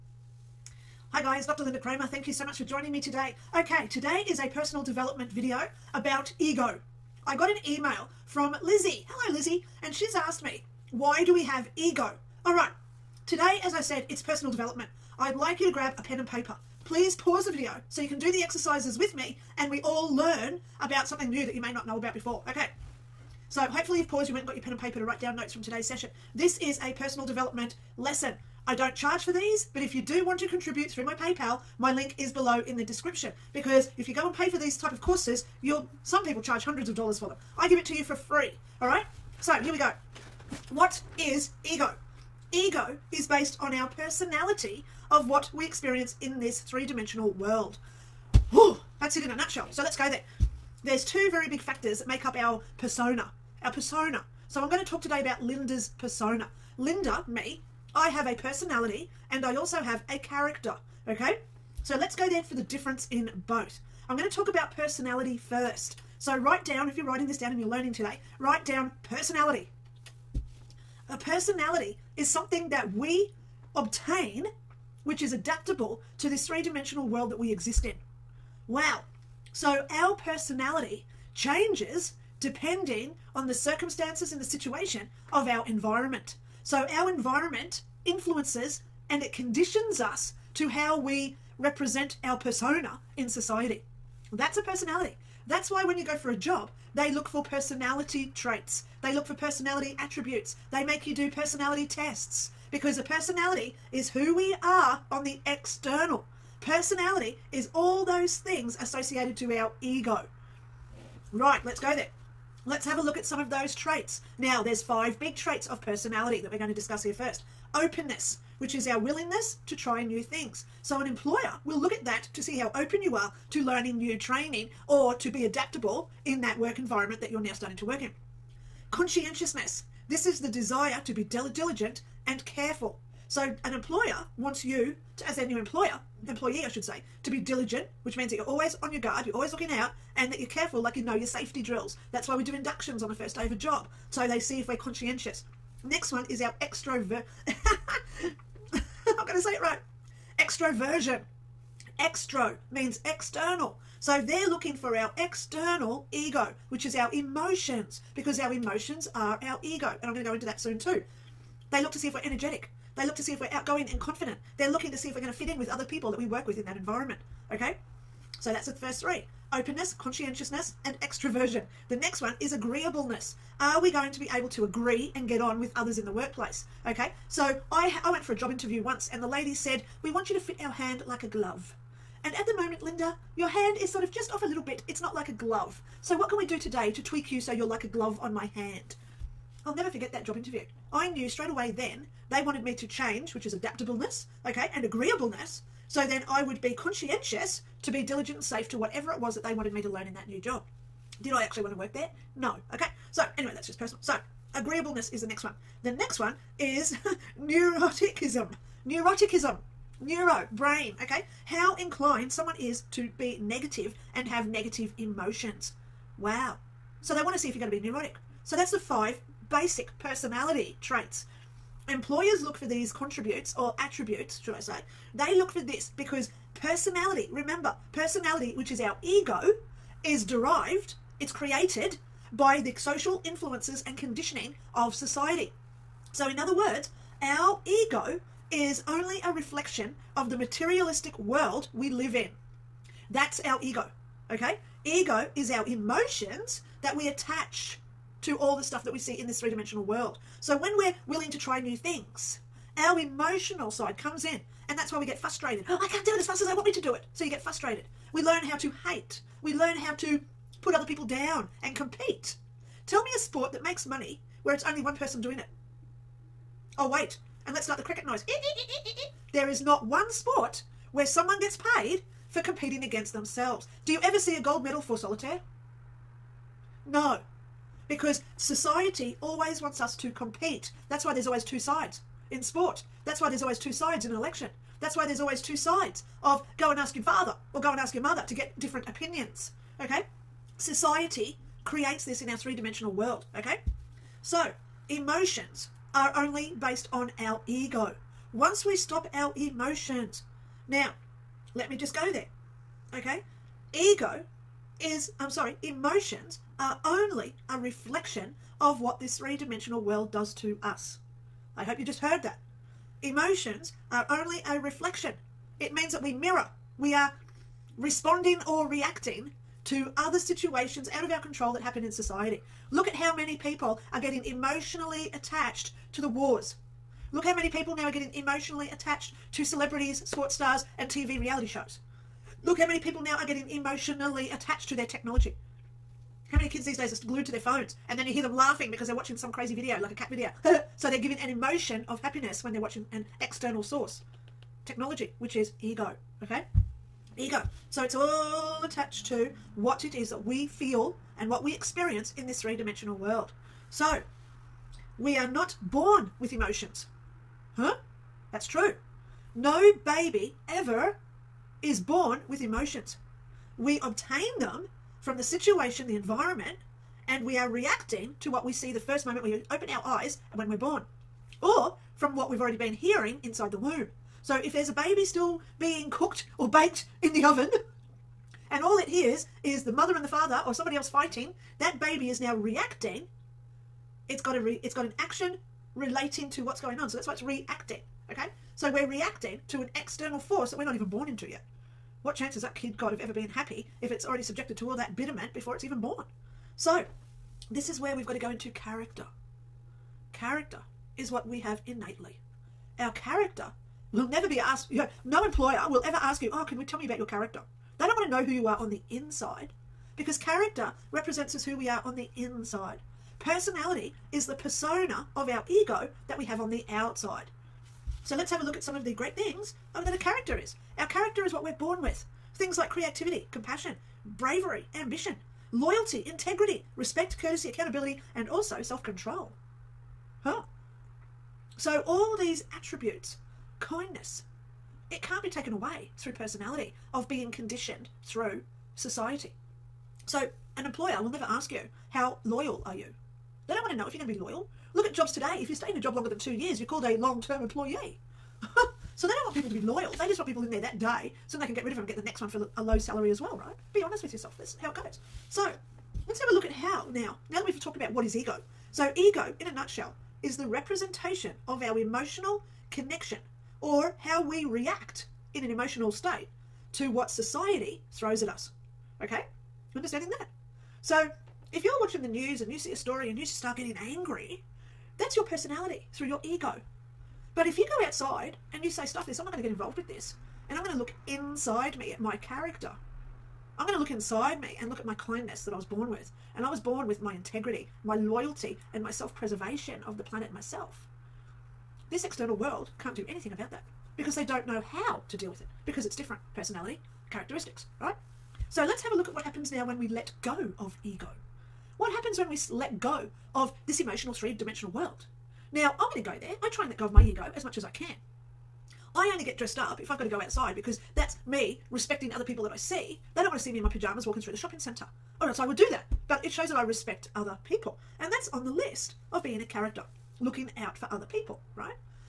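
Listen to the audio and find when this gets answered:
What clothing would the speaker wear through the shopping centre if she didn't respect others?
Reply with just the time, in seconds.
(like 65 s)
513 s.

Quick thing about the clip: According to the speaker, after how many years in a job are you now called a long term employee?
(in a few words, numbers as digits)
2.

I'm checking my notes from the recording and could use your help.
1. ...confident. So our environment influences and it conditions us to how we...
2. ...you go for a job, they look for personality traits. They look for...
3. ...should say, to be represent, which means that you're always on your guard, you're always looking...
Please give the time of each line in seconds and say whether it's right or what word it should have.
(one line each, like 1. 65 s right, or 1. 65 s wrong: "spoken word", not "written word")
1. 85 s wrong: "environment", not "confident"
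2. 95 s right
3. 136 s wrong: "diligent", not "represent".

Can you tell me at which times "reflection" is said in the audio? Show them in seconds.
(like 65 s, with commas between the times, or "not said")
239 s, 307 s, 314 s.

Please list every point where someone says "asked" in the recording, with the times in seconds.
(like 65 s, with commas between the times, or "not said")
10 s, 404 s.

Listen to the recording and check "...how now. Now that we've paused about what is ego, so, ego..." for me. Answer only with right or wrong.
wrong.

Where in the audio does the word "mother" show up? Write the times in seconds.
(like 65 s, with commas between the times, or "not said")
288 s, 379 s.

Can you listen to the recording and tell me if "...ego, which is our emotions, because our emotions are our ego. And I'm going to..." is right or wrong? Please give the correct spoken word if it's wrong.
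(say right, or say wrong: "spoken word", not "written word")
right.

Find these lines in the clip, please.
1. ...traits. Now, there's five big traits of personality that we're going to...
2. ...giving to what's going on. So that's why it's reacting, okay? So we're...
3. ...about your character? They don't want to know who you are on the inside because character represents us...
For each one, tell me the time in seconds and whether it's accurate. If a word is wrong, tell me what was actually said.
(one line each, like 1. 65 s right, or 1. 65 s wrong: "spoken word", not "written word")
1. 113 s right
2. 385 s wrong: "relating", not "giving"
3. 406 s right.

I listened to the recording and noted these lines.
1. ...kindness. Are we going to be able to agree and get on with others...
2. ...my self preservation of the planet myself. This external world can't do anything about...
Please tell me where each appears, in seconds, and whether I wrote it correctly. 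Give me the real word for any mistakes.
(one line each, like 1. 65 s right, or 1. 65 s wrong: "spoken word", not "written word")
1. 172 s wrong: "agreeableness", not "kindness"
2. 488 s right.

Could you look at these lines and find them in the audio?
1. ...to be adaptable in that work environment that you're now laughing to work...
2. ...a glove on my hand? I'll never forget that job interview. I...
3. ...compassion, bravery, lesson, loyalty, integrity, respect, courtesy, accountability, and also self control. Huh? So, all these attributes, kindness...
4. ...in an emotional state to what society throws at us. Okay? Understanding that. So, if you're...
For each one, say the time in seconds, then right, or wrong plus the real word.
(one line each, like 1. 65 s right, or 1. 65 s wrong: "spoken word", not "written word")
1. 125 s wrong: "starting", not "laughing"
2. 187 s right
3. 423 s wrong: "ambition", not "lesson"
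4. 465 s right.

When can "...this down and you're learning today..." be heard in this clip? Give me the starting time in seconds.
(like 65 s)
67 s.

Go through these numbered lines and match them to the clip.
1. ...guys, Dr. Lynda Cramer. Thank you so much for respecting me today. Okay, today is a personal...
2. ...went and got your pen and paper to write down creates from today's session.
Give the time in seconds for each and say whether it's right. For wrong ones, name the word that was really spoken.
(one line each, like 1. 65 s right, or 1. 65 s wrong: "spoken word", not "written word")
1. 1 s wrong: "joining", not "respecting"
2. 24 s wrong: "notes", not "creates".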